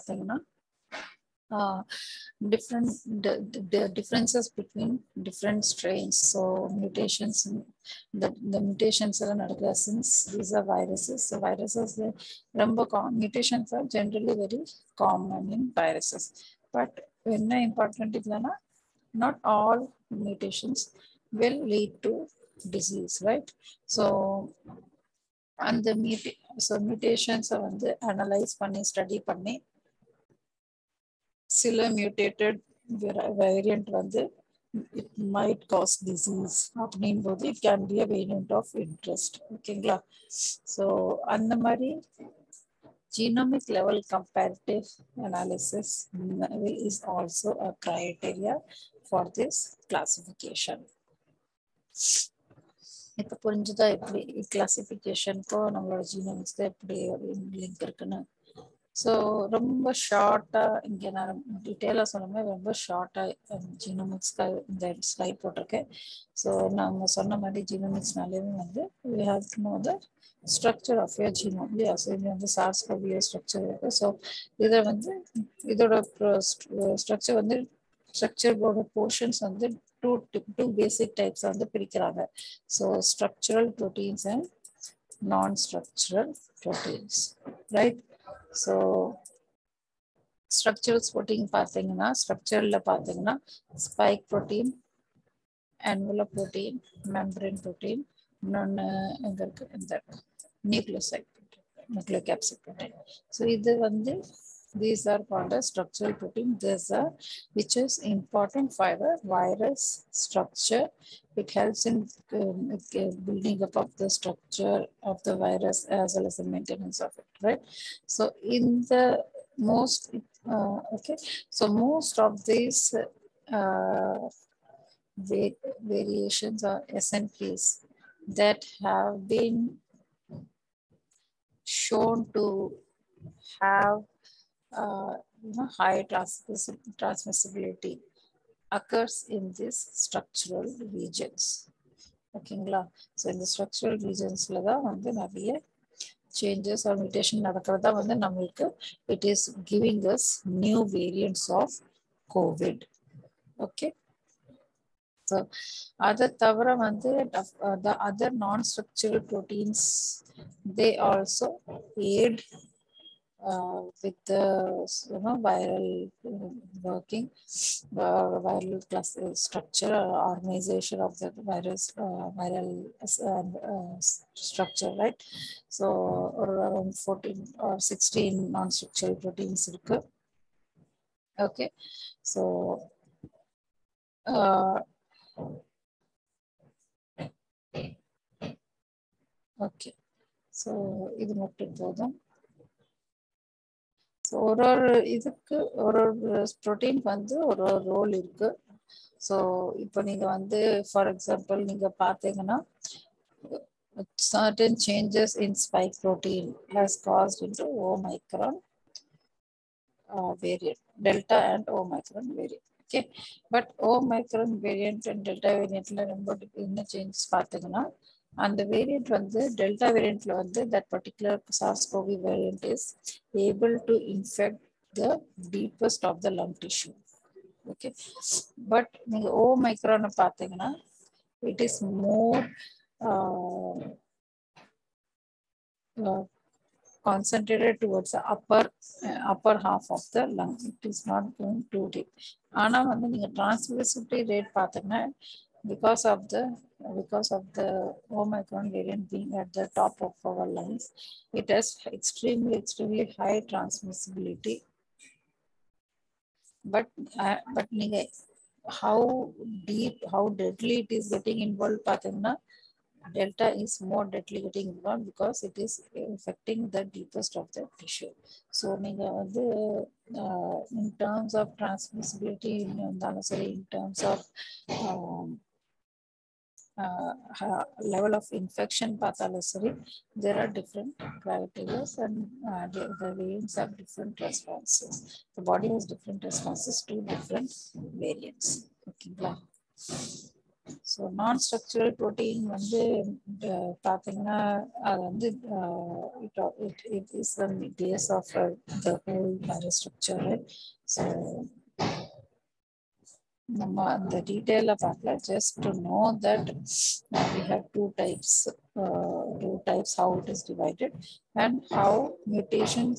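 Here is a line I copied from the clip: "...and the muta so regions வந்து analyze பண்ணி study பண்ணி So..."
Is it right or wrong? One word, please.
wrong.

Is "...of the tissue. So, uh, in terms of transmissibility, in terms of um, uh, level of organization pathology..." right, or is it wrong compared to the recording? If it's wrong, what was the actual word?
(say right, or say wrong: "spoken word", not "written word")
wrong: "infection", not "organization".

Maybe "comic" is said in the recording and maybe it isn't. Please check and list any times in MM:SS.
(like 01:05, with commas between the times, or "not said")
not said.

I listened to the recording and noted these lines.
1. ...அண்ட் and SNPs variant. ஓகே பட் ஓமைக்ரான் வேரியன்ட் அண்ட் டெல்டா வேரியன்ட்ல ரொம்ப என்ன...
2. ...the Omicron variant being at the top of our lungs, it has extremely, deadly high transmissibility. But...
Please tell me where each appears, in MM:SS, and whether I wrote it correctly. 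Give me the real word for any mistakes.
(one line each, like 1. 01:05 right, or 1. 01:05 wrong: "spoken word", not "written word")
1. 03:31 wrong: "Omicron", not "SNPs"
2. 04:07 wrong: "extremely", not "deadly".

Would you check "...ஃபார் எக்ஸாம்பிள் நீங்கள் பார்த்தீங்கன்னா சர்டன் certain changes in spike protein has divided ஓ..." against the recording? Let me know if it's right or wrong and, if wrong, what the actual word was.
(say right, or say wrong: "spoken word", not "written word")
wrong: "caused", not "divided".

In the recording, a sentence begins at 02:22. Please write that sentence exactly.
Okay, so in the structural regions, the changes or mutation, the, it is giving us new variants of COVID.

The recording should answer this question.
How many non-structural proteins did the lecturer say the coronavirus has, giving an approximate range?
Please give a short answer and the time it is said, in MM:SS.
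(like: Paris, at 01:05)
14 or 16, at 02:56.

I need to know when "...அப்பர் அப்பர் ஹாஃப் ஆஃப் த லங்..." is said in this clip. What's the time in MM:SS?
03:58.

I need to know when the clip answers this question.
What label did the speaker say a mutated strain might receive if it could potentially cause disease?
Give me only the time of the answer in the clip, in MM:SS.
00:38.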